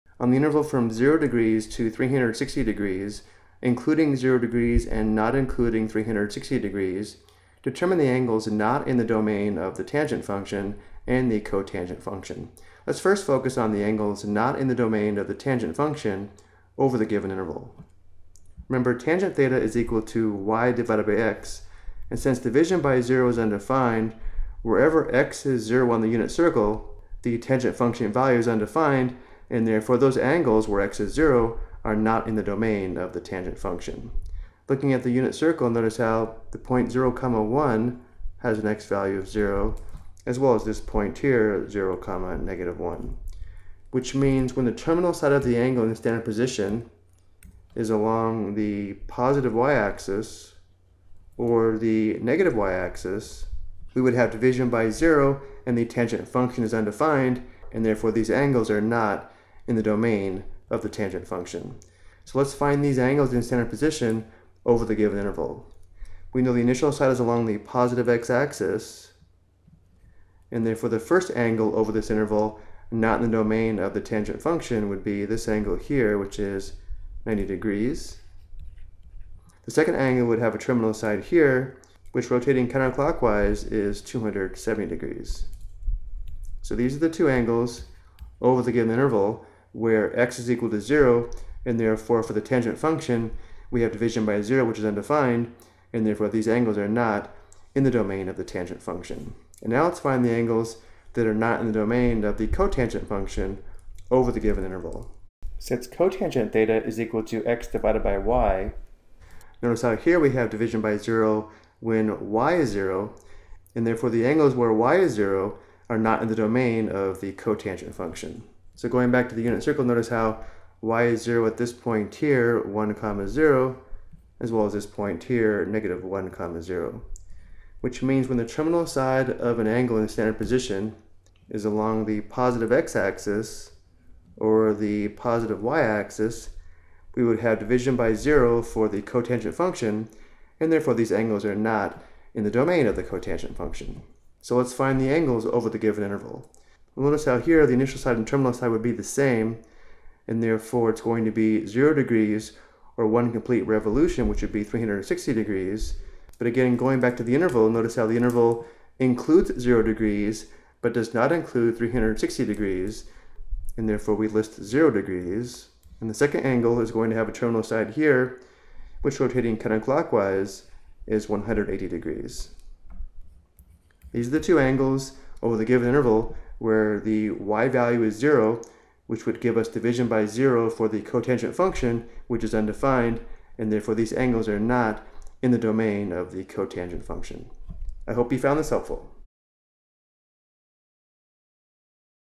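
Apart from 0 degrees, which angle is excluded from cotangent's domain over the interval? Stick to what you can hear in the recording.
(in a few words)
180 degrees.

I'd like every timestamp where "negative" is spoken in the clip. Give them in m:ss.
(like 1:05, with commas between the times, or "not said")
0:42, 0:52, 2:05.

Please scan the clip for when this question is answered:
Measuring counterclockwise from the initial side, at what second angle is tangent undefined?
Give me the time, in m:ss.
1:24.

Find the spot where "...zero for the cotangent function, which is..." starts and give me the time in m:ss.
3:00.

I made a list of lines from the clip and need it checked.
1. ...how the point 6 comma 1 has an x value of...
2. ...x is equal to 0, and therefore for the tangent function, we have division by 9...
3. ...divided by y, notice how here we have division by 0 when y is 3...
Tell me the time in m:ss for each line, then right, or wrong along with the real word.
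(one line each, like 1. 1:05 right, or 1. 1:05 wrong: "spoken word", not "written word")
1. 0:35 wrong: "0", not "6"
2. 1:30 wrong: "0", not "9"
3. 1:47 wrong: "0", not "3".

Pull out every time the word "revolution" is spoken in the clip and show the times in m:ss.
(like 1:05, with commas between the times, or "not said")
2:33.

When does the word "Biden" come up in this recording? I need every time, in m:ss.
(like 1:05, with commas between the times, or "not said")
not said.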